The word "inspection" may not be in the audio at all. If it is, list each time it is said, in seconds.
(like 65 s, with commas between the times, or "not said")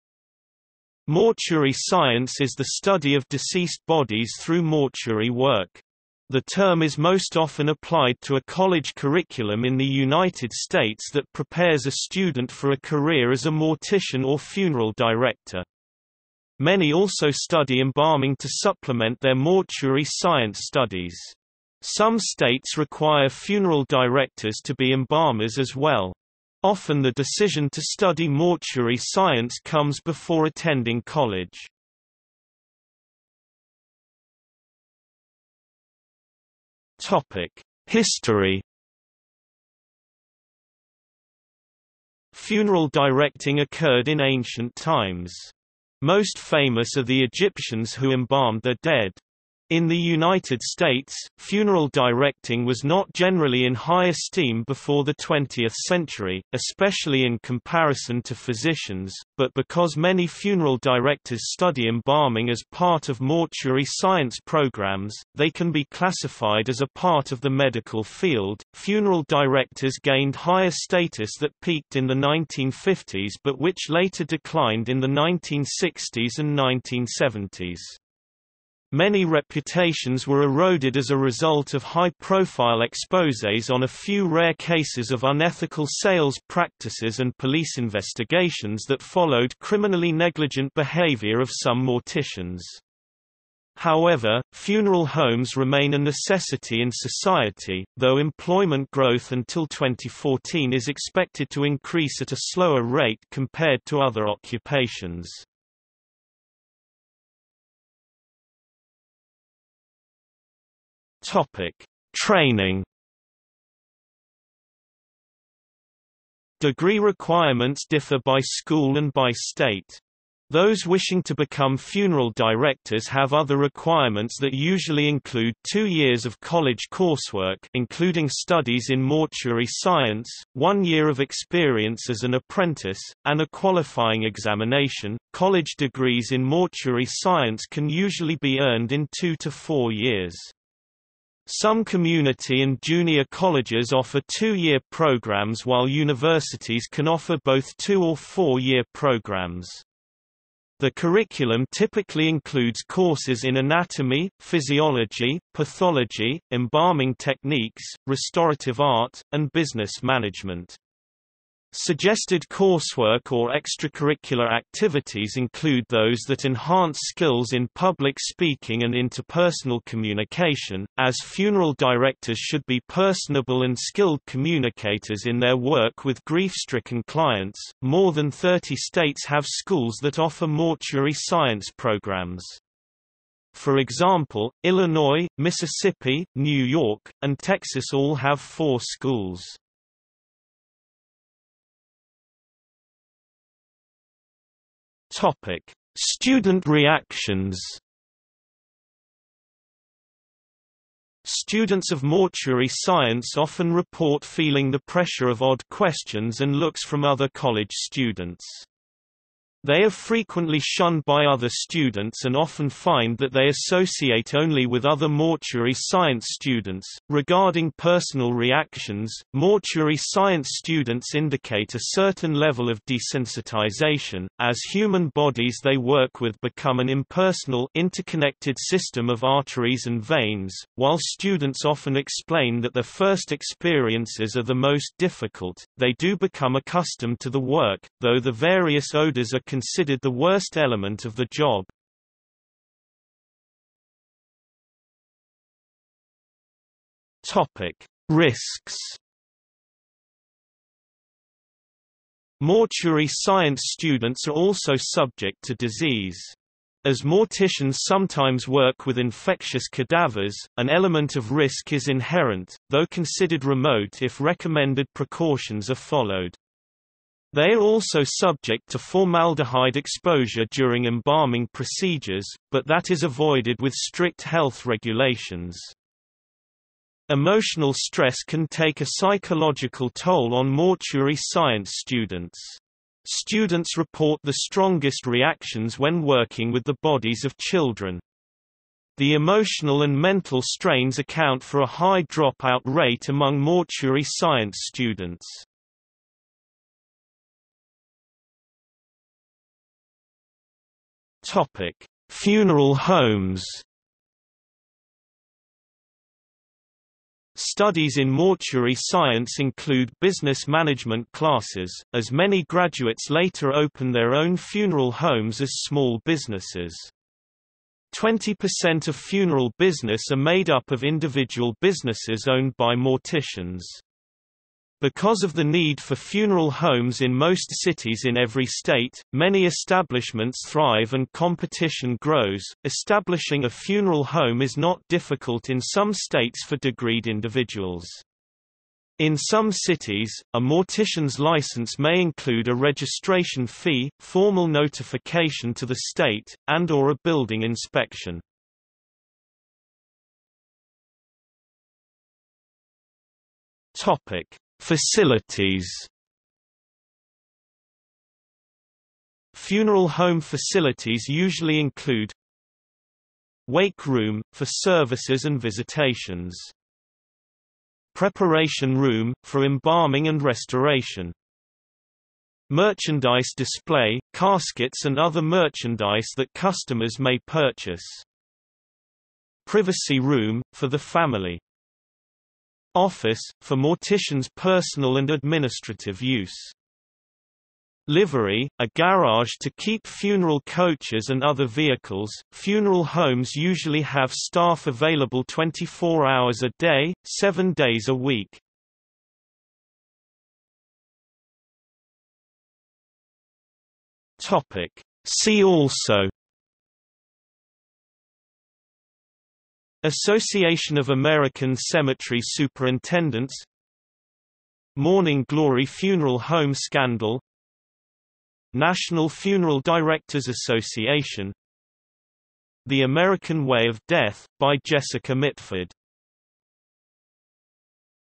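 347 s.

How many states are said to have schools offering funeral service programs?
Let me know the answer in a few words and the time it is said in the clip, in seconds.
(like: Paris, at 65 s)
More than 30, at 177 s.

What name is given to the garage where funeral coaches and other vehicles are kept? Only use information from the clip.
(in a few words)
Livery.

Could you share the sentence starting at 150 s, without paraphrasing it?
The curriculum typically includes courses in anatomy, physiology, pathology, embalming techniques, restorative art, and business management.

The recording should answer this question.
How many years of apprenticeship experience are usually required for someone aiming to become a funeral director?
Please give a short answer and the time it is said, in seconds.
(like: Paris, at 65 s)
1 year, at 130 s.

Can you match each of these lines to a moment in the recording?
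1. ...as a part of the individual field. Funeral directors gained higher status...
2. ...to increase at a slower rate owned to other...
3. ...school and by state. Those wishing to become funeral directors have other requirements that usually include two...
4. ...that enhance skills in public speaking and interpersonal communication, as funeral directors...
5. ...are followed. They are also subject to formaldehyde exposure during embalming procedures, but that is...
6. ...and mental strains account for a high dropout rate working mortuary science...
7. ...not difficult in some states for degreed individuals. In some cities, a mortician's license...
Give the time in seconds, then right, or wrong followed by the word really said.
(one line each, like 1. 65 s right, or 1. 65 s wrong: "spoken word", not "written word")
1. 66 s wrong: "medical", not "individual"
2. 101 s wrong: "compared", not "owned"
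3. 118 s right
4. 166 s right
5. 265 s right
6. 289 s wrong: "among", not "working"
7. 334 s right.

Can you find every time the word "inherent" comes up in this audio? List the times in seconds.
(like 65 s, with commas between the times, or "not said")
261 s.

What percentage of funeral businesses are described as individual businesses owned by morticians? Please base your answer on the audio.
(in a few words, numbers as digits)
20%.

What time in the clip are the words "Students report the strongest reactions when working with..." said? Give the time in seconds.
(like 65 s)
283 s.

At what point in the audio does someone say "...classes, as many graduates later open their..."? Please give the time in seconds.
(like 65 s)
311 s.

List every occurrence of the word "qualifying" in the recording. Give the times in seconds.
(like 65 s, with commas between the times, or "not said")
133 s.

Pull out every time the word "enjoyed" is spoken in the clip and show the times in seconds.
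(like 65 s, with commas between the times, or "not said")
not said.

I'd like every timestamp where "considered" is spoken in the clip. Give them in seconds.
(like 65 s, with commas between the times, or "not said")
239 s, 262 s.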